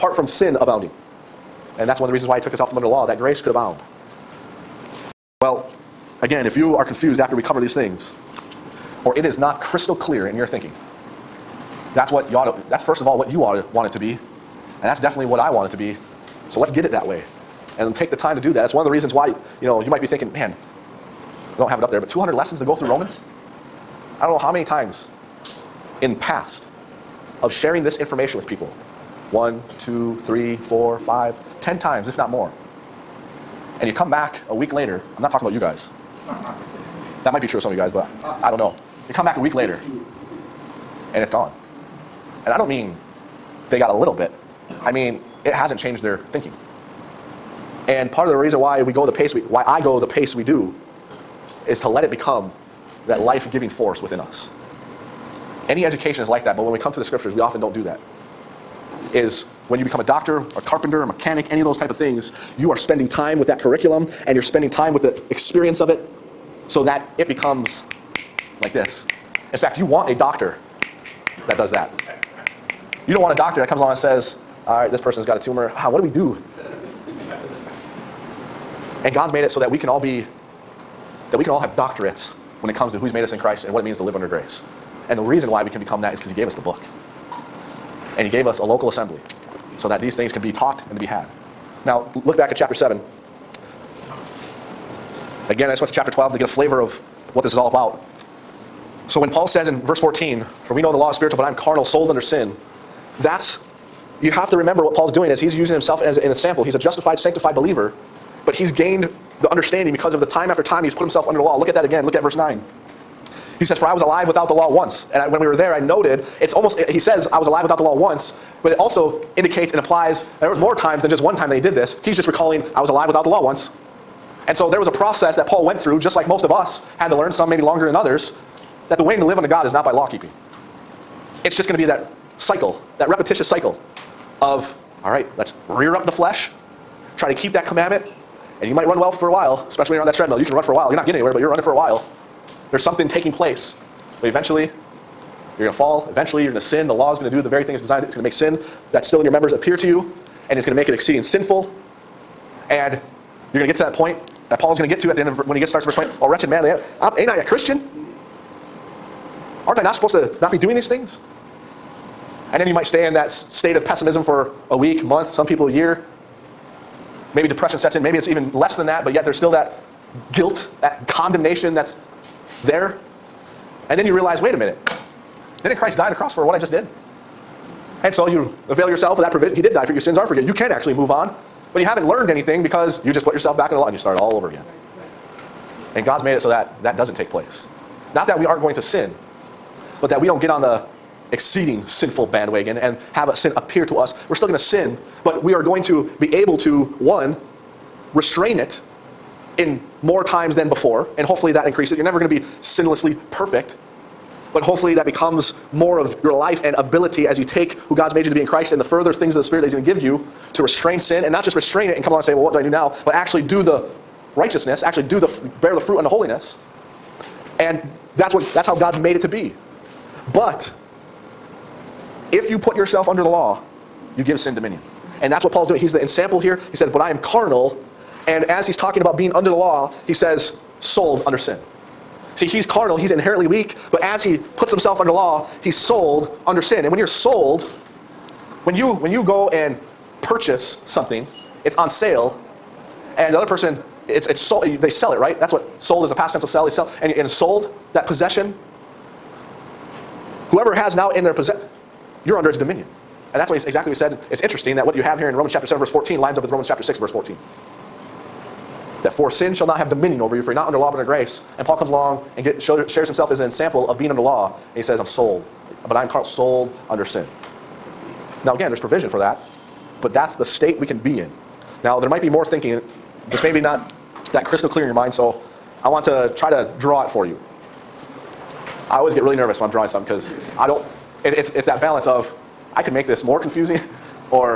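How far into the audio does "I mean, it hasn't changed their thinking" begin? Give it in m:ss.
0:44.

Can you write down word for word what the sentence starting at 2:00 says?
There was more times than just one time that he did this.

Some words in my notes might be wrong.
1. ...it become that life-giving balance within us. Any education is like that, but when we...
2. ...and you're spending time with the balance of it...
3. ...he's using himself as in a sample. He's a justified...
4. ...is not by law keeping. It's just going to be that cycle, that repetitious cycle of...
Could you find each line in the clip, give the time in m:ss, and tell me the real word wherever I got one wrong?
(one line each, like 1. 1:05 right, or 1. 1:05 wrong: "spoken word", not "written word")
1. 0:52 wrong: "force", not "balance"
2. 1:04 wrong: "experience", not "balance"
3. 1:45 right
4. 2:09 right.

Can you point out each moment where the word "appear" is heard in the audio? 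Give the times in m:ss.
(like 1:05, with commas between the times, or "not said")
2:29, 3:13.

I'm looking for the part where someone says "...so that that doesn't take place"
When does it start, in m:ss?
3:06.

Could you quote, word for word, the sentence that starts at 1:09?
In fact, you want a doctor that does that.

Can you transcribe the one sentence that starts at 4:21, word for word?
And Paul comes along and get, show, shares himself as an example of being under law.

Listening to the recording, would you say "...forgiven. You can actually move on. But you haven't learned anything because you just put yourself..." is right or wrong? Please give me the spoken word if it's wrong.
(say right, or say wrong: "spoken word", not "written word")
right.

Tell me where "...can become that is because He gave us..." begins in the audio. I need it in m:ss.
1:25.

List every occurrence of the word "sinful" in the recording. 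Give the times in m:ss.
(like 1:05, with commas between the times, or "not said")
2:31, 3:11.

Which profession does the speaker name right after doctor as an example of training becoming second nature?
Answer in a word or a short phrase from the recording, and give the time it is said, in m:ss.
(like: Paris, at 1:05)
carpenter, at 1:00.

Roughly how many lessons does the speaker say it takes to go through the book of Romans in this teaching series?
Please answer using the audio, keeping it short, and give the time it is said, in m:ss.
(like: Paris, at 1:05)
200, at 0:22.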